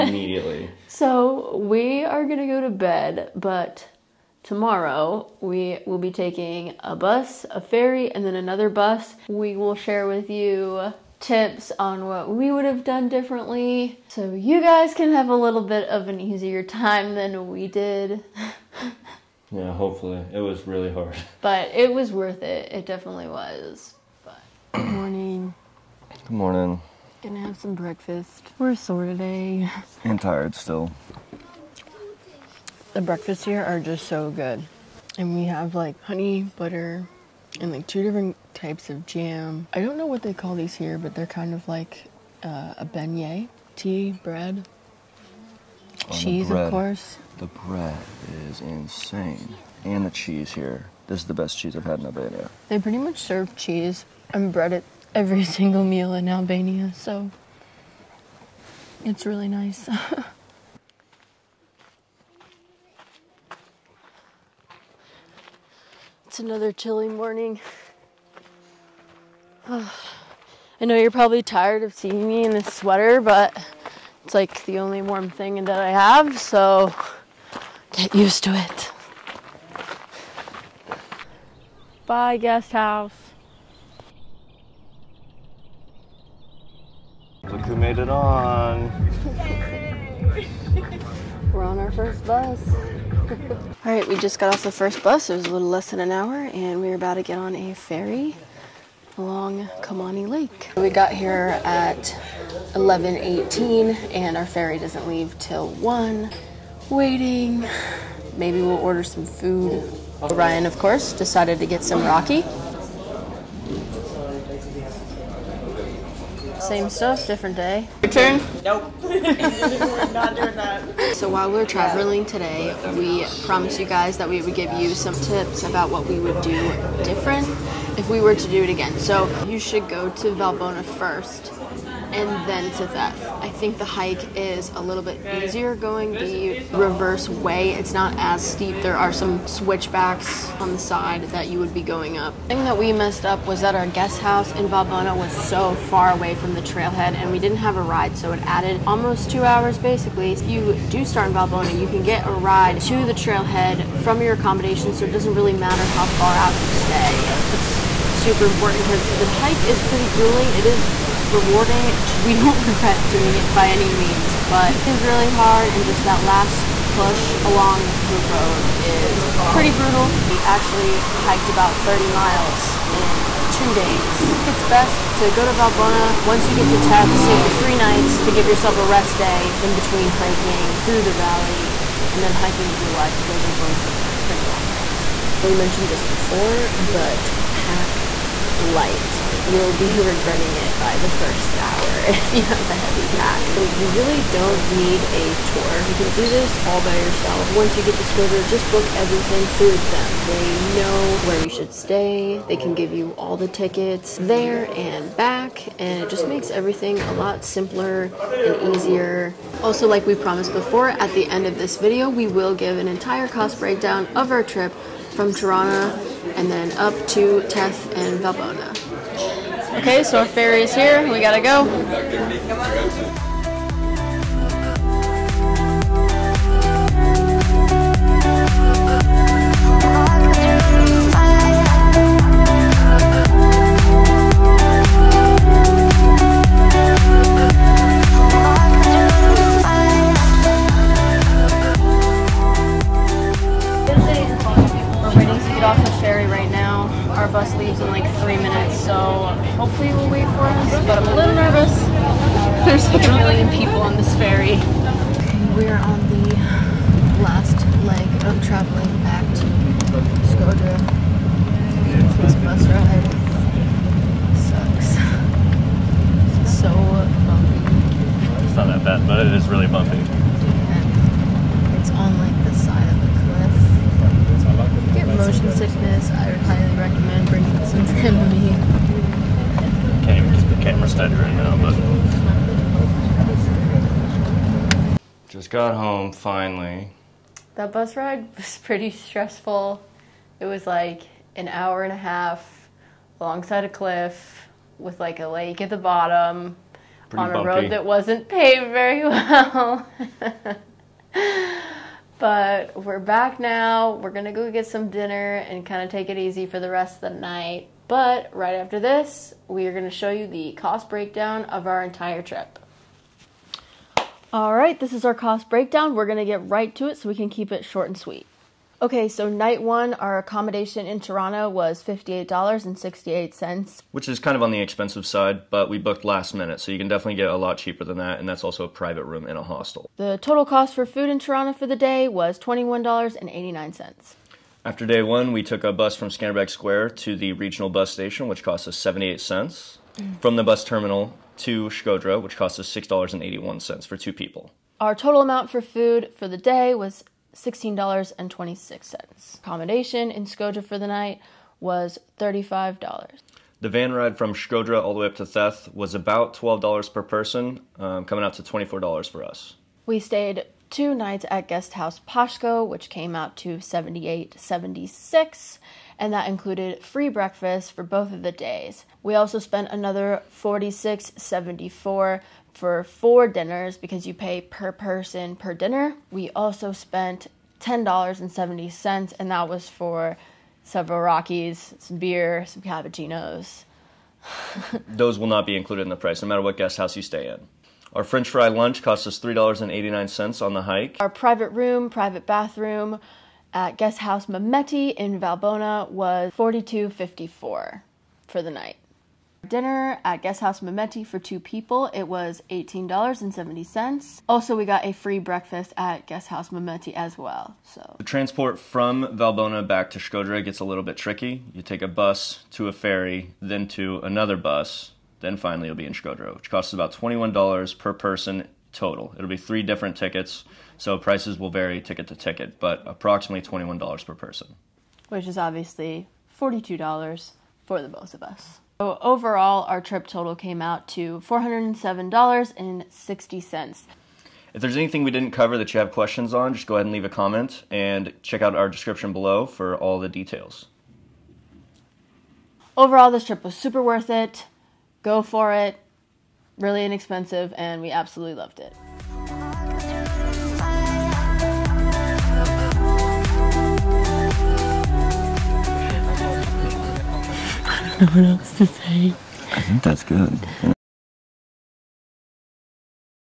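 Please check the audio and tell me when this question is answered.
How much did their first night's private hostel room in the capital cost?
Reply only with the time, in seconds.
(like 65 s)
321 s.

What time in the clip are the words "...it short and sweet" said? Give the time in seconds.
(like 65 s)
317 s.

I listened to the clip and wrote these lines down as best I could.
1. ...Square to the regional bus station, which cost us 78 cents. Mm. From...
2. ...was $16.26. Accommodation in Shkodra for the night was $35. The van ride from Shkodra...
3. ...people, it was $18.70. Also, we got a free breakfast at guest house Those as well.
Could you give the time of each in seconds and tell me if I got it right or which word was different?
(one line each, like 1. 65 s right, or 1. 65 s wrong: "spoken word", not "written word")
1. 336 s right
2. 346 s right
3. 401 s wrong: "Mehmeti", not "Those".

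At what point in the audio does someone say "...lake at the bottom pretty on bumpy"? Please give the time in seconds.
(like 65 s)
295 s.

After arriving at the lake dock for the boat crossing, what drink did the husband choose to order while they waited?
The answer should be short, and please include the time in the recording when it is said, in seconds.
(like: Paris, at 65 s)
raki, at 112 s.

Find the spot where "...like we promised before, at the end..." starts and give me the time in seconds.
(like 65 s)
209 s.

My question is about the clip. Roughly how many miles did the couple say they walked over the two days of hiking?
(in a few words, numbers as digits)
30 miles.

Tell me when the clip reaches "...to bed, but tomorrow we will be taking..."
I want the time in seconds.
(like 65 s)
2 s.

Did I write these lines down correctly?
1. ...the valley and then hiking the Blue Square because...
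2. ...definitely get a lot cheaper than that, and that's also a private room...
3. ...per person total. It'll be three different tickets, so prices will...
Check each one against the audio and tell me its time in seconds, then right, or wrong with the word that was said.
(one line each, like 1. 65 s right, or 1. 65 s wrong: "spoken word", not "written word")
1. 181 s wrong: "Eye", not "Square"
2. 326 s right
3. 417 s right.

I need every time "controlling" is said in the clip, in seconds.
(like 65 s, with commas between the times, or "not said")
not said.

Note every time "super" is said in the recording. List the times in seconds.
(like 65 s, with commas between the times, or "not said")
158 s, 443 s.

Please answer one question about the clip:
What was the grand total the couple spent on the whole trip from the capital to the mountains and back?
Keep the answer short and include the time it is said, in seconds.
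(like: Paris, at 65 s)
$407.60, at 431 s.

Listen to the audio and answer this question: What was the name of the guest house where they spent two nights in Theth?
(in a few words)
Pashko.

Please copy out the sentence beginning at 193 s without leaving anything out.
You really don't need a tour.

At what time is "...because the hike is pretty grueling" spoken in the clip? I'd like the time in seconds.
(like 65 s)
158 s.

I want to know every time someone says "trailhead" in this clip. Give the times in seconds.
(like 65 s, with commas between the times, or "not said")
146 s, 153 s.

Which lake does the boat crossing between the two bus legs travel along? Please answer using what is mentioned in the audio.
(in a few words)
Komani Lake.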